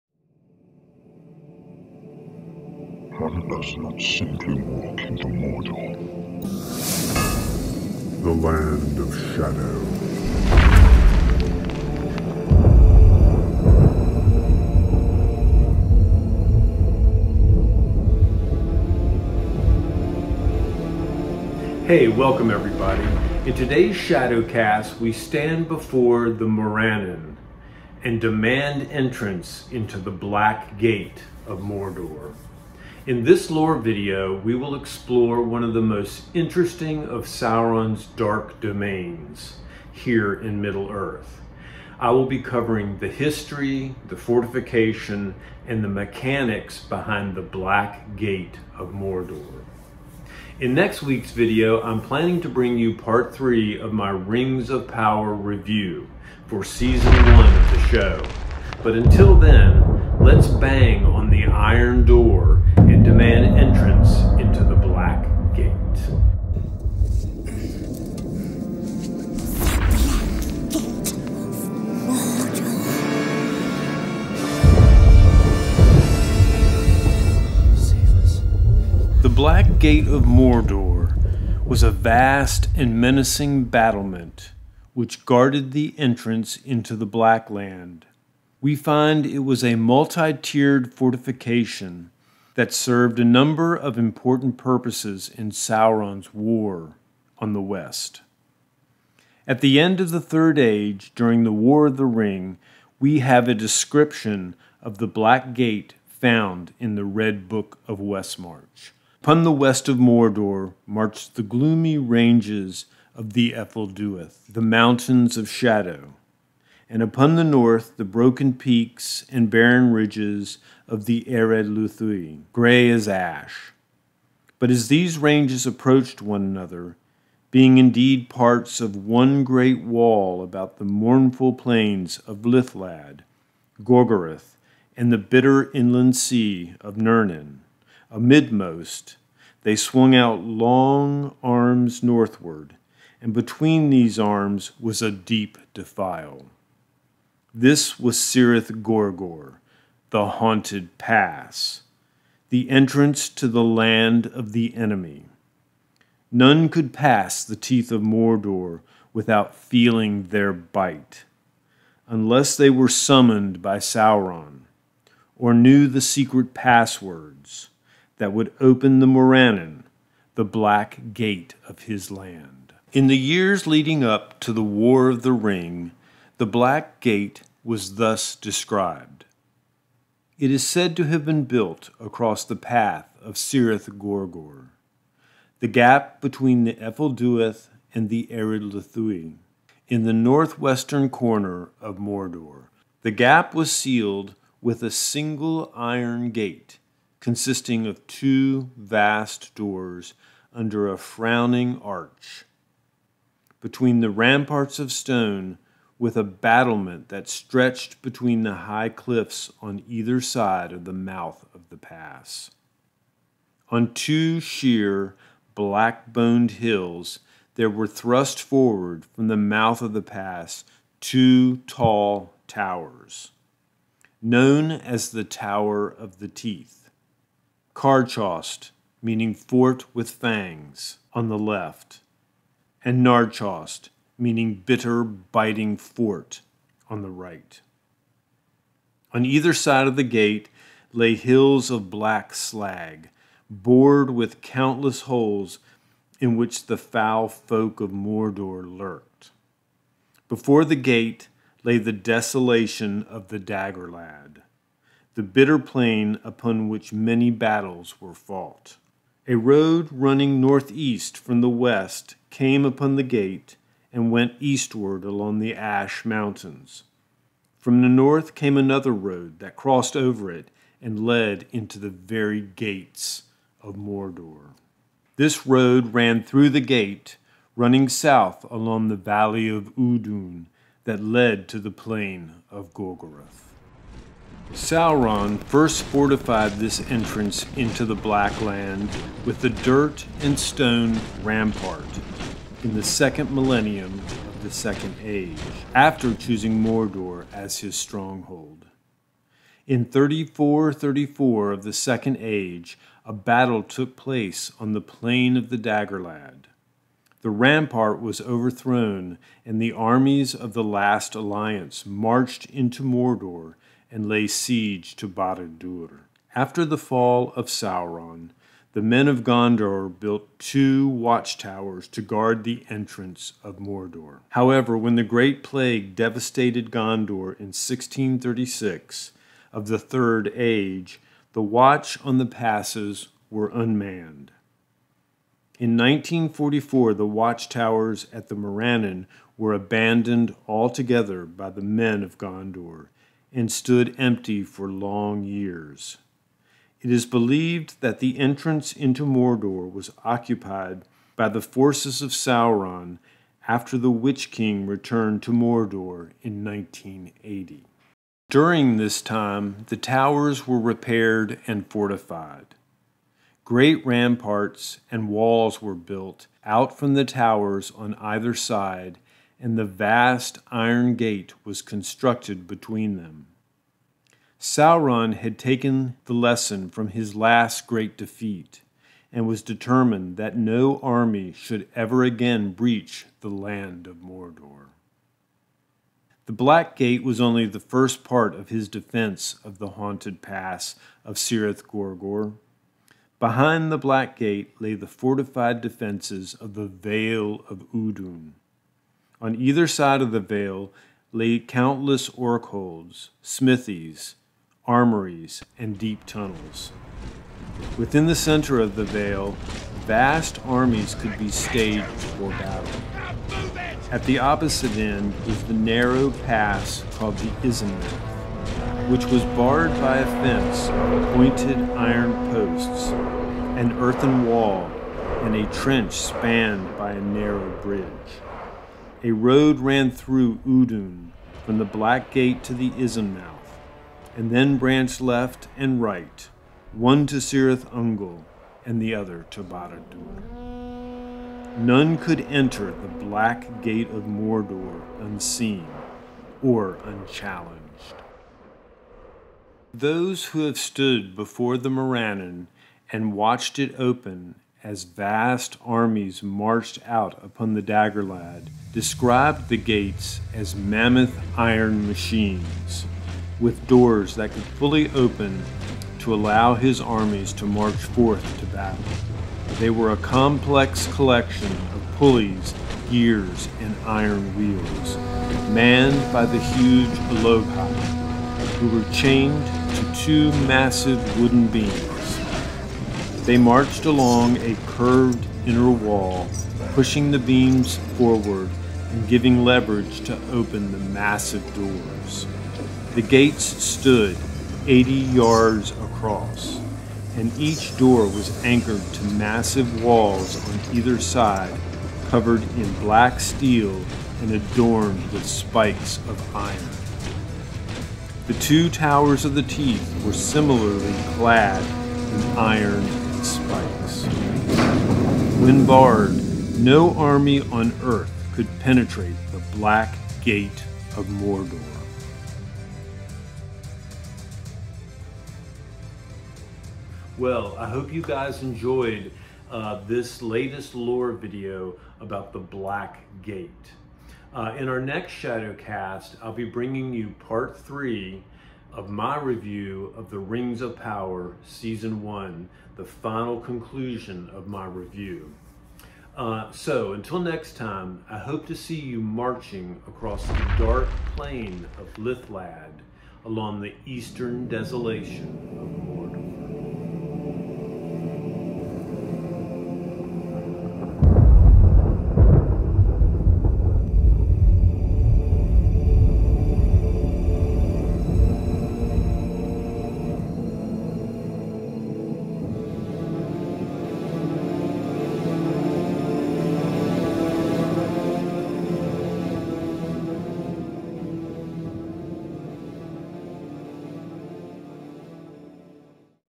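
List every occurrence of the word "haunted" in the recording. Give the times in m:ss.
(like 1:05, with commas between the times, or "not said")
2:30, 6:29.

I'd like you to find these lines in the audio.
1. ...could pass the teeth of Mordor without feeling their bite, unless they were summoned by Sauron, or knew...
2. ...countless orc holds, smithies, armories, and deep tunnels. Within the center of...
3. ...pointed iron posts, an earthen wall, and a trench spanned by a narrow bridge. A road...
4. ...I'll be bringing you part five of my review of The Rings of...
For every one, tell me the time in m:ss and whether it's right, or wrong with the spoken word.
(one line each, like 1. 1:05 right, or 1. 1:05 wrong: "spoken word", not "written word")
1. 2:36 right
2. 6:41 right
3. 7:01 right
4. 8:56 wrong: "three", not "five".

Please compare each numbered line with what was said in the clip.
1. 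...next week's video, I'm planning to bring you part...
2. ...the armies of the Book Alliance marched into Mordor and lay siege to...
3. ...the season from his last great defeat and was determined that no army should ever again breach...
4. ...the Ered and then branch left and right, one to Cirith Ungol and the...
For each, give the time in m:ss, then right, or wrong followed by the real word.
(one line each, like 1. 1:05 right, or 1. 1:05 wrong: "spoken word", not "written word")
1. 0:50 right
2. 5:09 wrong: "Last", not "Book"
3. 6:16 wrong: "lesson", not "season"
4. 7:12 wrong: "Isenmouthe", not "Ered".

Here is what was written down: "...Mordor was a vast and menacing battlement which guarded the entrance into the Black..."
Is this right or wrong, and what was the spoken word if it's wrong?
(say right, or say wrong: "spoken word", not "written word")
right.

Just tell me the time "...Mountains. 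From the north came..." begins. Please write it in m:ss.
4:26.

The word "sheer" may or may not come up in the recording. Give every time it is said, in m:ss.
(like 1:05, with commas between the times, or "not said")
3:34.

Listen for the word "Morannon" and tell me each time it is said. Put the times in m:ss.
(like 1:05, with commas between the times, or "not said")
0:26, 2:49, 5:38, 7:31.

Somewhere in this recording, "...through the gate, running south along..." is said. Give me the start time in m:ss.
4:36.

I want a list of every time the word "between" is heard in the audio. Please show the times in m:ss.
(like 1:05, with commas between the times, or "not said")
2:23, 3:06, 3:23, 3:28, 6:12.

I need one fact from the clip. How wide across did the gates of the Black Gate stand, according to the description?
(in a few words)
80 yards.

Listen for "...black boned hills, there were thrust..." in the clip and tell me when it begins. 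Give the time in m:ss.
3:35.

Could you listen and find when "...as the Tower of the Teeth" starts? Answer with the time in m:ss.
3:44.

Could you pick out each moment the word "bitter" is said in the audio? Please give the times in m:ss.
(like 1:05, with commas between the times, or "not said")
2:15, 3:54, 4:15.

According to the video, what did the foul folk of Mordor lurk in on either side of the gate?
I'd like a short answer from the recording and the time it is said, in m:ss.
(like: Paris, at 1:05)
hills of black slag, at 4:01.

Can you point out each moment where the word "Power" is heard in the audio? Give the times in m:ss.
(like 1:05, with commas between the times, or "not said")
0:54, 9:00.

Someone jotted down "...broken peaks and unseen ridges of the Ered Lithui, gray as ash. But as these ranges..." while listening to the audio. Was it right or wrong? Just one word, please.
wrong.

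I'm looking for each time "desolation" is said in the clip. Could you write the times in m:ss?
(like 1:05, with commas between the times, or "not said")
4:11, 9:14.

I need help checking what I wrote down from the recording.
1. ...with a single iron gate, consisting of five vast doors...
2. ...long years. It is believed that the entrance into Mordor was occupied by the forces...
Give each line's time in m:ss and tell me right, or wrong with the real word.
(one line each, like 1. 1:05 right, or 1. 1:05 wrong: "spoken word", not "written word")
1. 3:14 wrong: "two", not "five"
2. 5:44 right.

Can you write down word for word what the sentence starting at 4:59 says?
In 3434 of the Second Age, a battle took place on the plain of the Dagorlad.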